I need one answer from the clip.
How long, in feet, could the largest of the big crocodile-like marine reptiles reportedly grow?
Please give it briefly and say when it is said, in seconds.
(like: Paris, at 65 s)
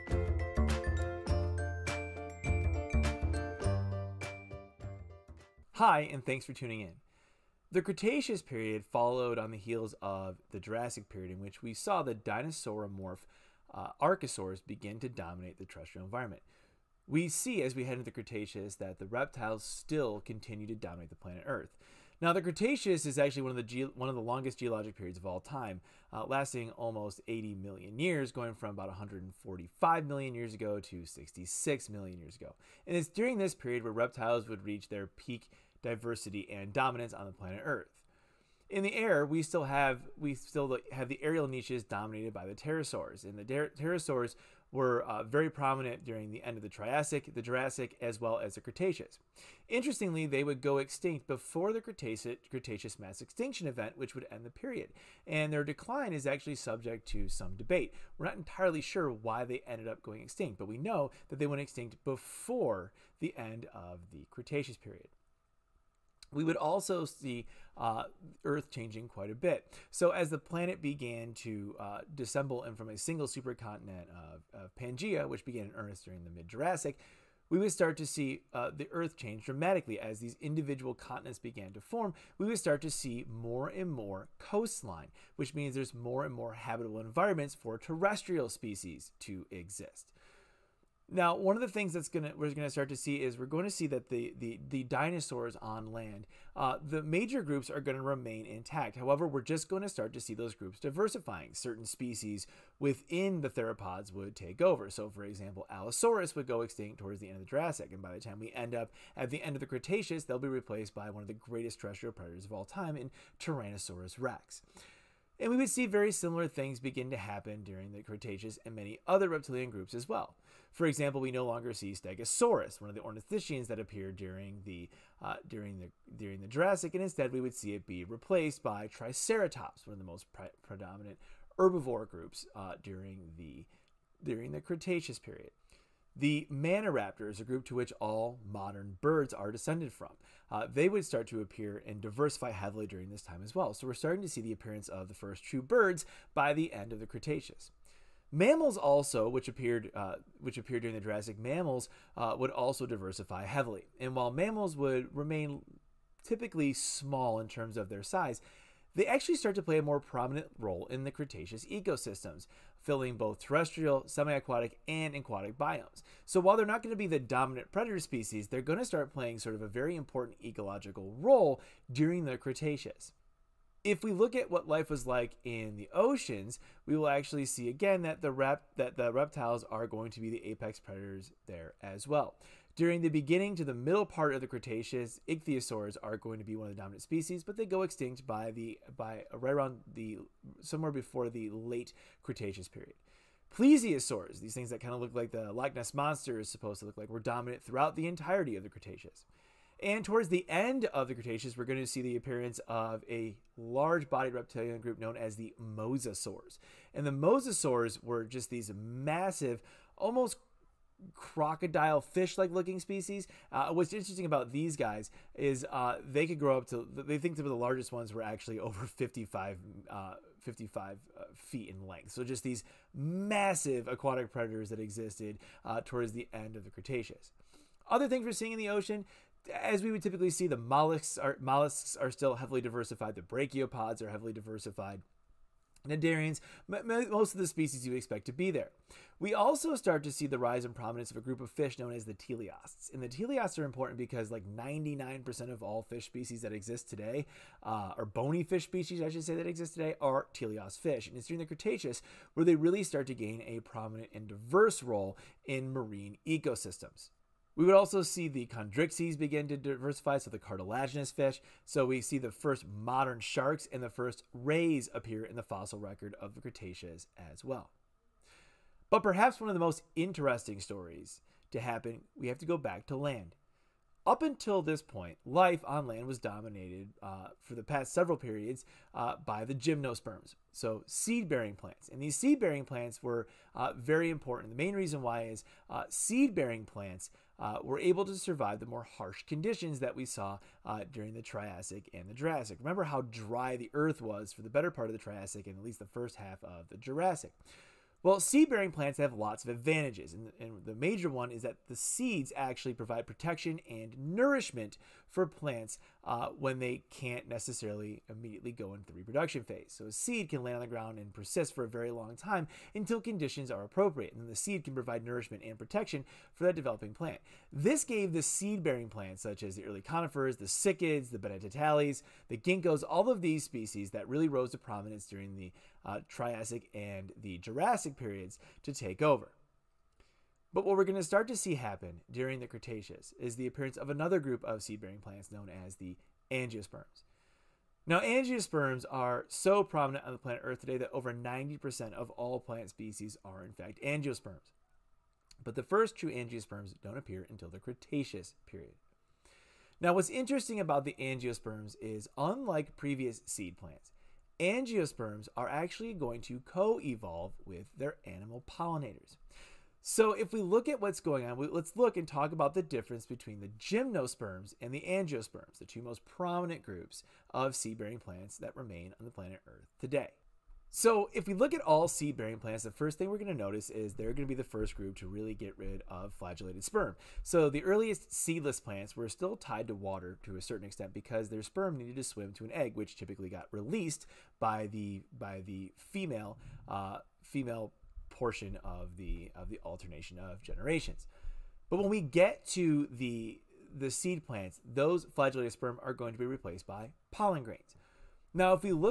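over 55 feet, at 218 s.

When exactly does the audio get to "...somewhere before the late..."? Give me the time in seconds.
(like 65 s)
190 s.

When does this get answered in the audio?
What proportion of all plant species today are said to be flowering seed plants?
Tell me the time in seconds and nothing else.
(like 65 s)
340 s.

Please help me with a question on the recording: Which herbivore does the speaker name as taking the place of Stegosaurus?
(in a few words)
Triceratops.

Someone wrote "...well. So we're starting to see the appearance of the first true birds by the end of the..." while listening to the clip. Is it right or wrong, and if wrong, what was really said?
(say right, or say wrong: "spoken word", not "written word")
right.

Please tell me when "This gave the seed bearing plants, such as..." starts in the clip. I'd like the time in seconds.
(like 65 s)
317 s.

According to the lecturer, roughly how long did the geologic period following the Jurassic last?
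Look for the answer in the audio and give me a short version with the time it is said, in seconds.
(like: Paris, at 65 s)
almost 80 million years, at 26 s.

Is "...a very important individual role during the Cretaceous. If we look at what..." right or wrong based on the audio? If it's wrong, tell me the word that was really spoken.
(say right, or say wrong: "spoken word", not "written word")
wrong: "ecological", not "individual".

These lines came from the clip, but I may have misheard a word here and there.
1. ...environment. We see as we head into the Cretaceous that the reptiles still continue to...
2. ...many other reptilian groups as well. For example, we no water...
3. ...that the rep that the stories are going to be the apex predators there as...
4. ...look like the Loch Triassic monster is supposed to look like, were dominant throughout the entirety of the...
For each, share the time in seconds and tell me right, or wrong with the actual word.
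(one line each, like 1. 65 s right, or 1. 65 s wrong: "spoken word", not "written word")
1. 16 s right
2. 118 s wrong: "longer", not "water"
3. 178 s wrong: "reptiles", not "stories"
4. 195 s wrong: "Ness", not "Triassic".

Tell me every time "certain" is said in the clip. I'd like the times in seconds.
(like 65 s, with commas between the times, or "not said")
101 s, 380 s.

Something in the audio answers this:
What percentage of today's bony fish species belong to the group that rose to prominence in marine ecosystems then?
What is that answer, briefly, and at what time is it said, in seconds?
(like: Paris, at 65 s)
99%, at 244 s.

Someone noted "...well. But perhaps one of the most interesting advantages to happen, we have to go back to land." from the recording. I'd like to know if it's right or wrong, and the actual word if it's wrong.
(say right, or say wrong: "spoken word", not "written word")
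wrong: "stories", not "advantages".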